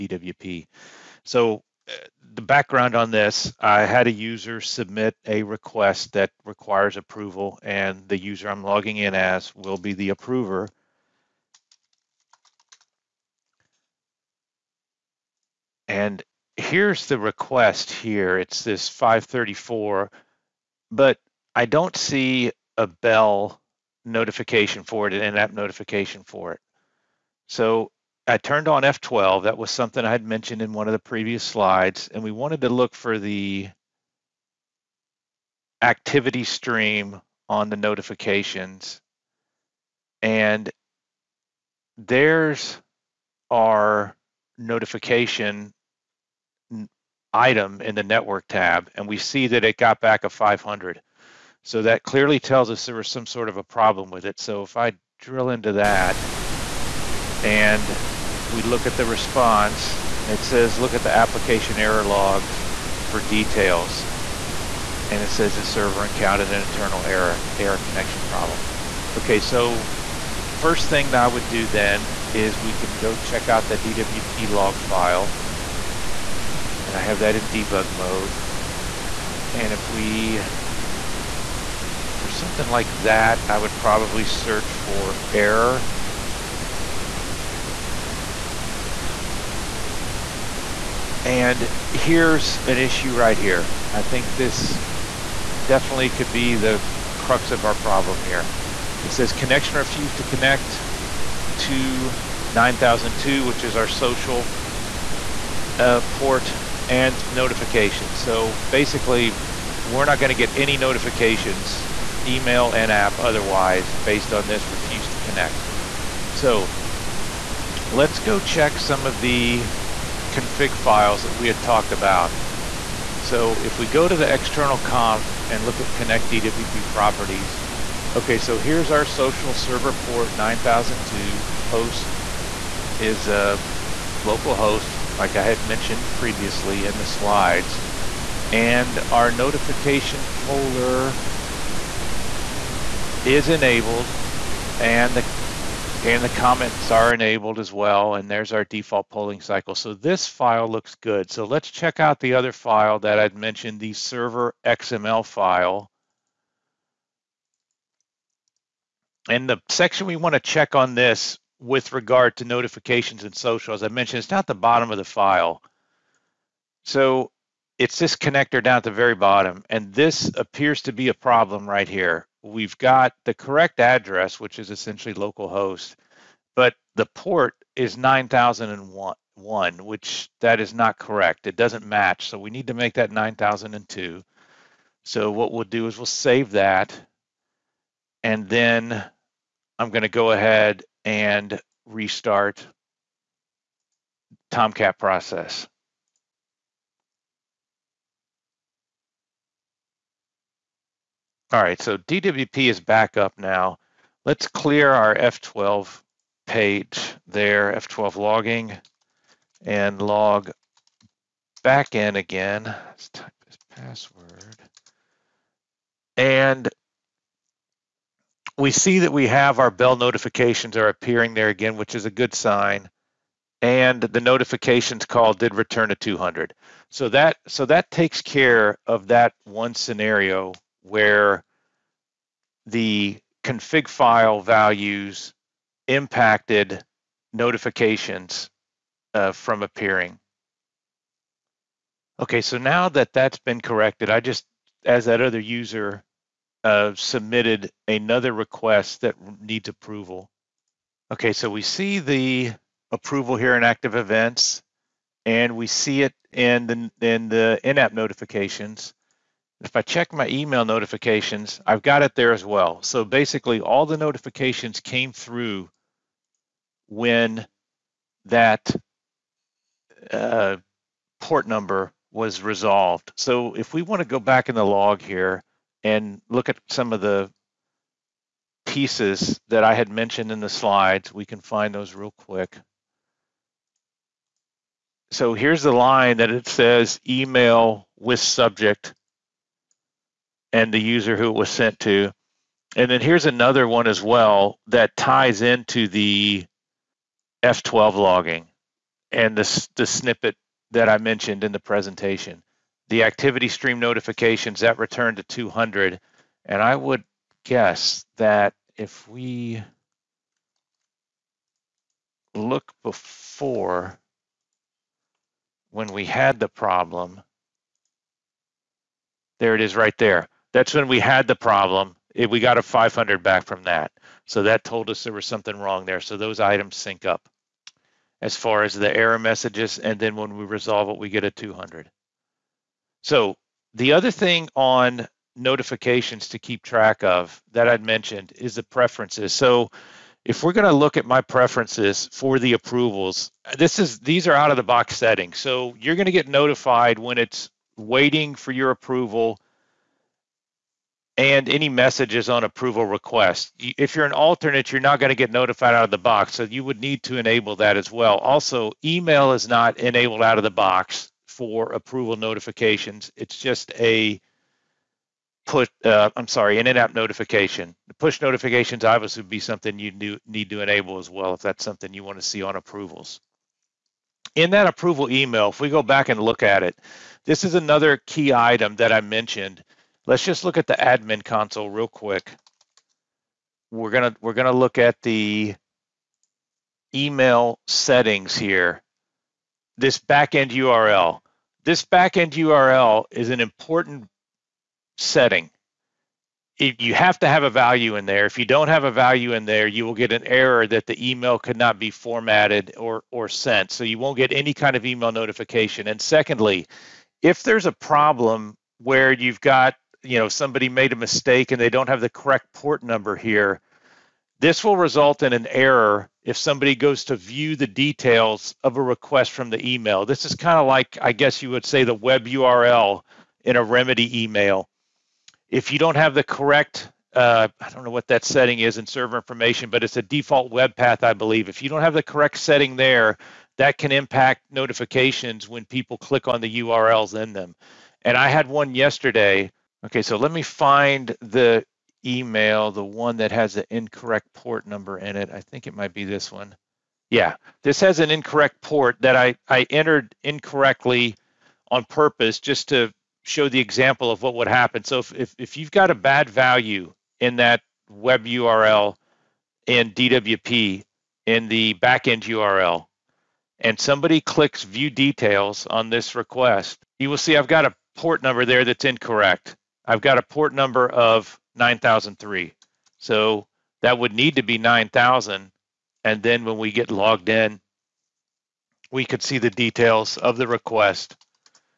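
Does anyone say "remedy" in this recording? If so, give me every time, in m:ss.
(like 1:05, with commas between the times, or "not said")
7:03.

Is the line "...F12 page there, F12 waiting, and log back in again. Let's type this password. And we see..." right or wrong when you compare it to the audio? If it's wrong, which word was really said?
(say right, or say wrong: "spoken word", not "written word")
wrong: "logging", not "waiting".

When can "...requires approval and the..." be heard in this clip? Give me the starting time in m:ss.
0:06.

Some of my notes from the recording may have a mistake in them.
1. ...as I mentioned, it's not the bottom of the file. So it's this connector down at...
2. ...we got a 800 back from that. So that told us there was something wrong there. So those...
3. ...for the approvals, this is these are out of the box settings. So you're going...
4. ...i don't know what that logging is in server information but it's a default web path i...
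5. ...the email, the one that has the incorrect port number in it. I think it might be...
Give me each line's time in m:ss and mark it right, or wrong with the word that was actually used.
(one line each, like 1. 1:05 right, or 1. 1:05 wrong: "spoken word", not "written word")
1. 2:43 right
2. 5:22 wrong: "500", not "800"
3. 5:42 right
4. 7:07 wrong: "setting", not "logging"
5. 7:21 right.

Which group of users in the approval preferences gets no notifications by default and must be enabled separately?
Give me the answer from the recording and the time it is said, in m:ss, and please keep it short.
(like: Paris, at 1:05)
alternate, at 5:54.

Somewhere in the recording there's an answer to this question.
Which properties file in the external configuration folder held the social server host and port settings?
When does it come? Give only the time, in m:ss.
2:05.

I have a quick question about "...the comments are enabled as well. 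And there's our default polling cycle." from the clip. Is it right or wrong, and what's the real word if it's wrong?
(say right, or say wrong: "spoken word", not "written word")
right.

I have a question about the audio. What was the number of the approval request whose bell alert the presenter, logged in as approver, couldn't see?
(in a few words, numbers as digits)
534.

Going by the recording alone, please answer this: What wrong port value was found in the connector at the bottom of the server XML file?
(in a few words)
9001.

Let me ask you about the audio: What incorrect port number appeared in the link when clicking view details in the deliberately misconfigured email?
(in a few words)
9003.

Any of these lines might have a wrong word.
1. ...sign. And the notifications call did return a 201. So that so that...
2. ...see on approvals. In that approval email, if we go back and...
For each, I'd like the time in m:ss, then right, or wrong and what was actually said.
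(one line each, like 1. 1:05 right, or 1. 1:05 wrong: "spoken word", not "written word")
1. 3:42 wrong: "200", not "201"
2. 6:12 right.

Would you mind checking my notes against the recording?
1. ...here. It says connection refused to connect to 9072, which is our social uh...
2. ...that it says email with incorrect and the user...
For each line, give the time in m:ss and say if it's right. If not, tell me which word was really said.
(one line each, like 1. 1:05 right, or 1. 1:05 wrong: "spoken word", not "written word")
1. 1:38 wrong: "9002", not "9072"
2. 4:46 wrong: "subject", not "incorrect".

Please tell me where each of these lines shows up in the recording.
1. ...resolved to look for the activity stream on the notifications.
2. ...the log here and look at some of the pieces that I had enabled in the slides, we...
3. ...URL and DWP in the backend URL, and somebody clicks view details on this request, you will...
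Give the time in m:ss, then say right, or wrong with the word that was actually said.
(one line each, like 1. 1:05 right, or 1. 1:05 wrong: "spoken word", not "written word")
1. 0:32 wrong: "wanted", not "resolved"
2. 4:34 wrong: "mentioned", not "enabled"
3. 7:38 right.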